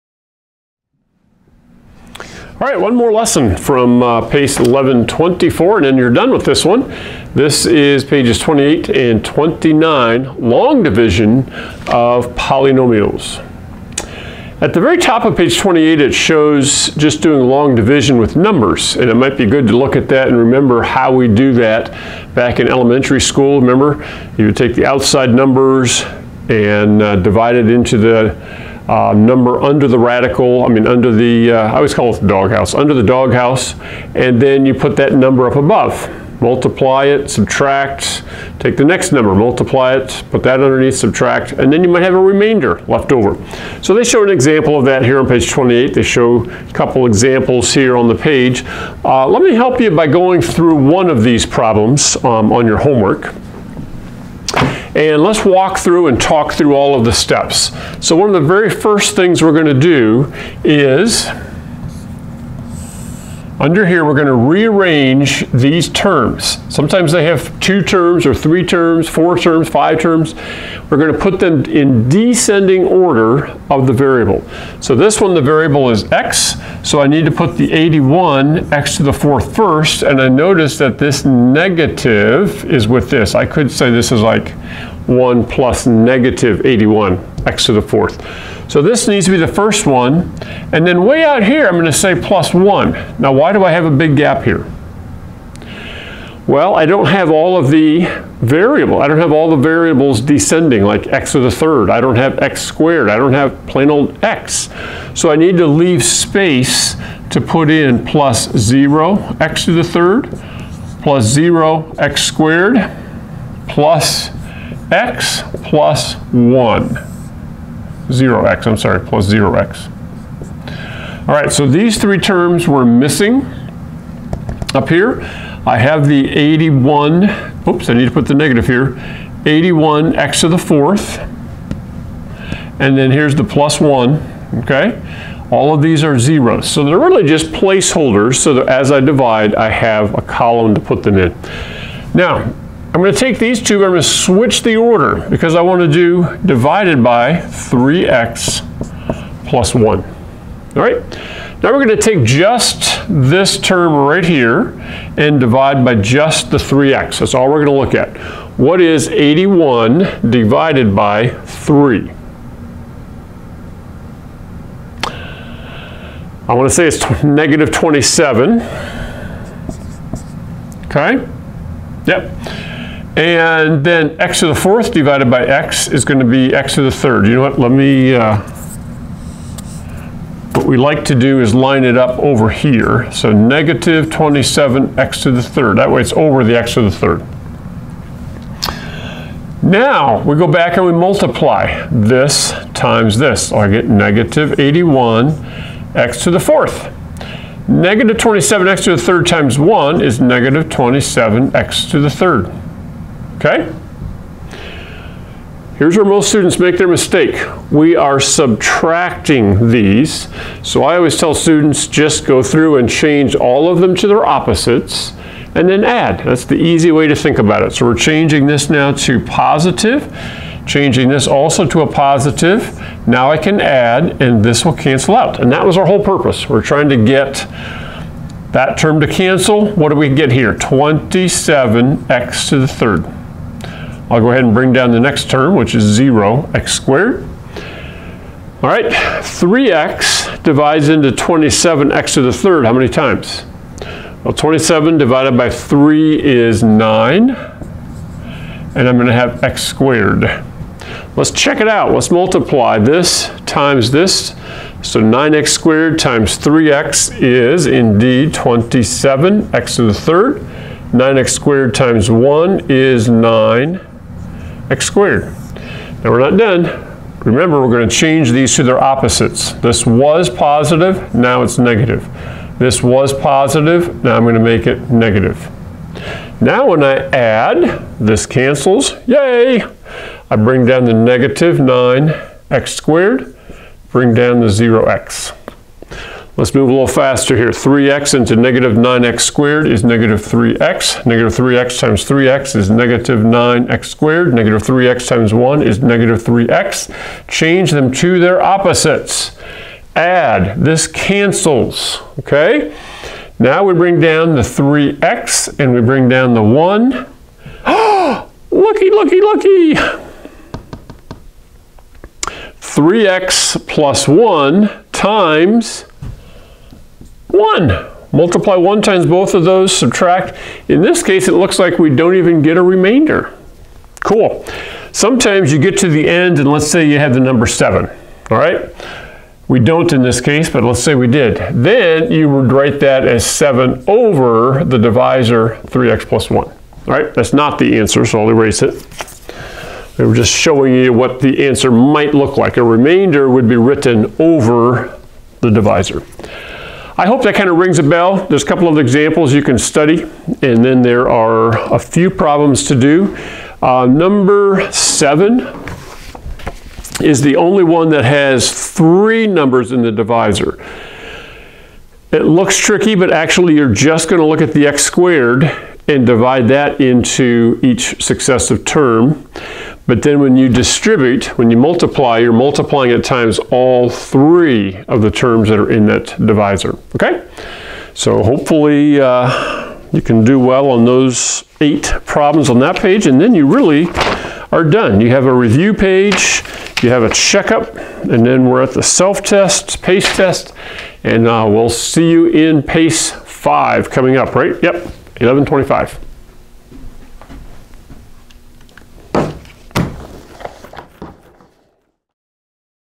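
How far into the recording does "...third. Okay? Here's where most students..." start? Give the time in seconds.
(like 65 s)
202 s.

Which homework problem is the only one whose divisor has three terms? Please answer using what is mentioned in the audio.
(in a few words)
Number 7.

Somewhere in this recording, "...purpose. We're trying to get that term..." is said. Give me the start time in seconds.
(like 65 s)
226 s.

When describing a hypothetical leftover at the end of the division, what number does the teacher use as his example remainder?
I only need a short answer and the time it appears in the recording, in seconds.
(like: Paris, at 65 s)
7, at 327 s.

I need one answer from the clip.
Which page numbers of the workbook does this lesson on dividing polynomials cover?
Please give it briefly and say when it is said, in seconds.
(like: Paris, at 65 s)
28 and 29, at 8 s.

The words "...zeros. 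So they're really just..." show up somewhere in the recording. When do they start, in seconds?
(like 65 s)
136 s.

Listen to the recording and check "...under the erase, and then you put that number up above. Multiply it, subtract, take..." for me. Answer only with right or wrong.
wrong.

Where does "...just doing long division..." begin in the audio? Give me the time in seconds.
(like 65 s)
16 s.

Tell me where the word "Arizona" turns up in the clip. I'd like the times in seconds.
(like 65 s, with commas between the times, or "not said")
not said.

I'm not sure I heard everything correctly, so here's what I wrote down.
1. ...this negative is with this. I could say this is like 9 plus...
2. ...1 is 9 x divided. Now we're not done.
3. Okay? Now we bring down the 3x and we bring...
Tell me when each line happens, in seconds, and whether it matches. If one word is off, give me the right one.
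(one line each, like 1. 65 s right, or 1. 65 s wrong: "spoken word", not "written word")
1. 80 s wrong: "1", not "9"
2. 262 s wrong: "squared", not "divided"
3. 302 s right.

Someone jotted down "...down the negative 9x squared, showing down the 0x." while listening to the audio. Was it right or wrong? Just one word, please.
wrong.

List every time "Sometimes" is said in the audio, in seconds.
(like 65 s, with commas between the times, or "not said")
66 s, 324 s.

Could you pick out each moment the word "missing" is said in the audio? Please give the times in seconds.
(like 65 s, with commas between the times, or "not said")
122 s.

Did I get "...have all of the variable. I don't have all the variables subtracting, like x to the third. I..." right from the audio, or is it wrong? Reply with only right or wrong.
wrong.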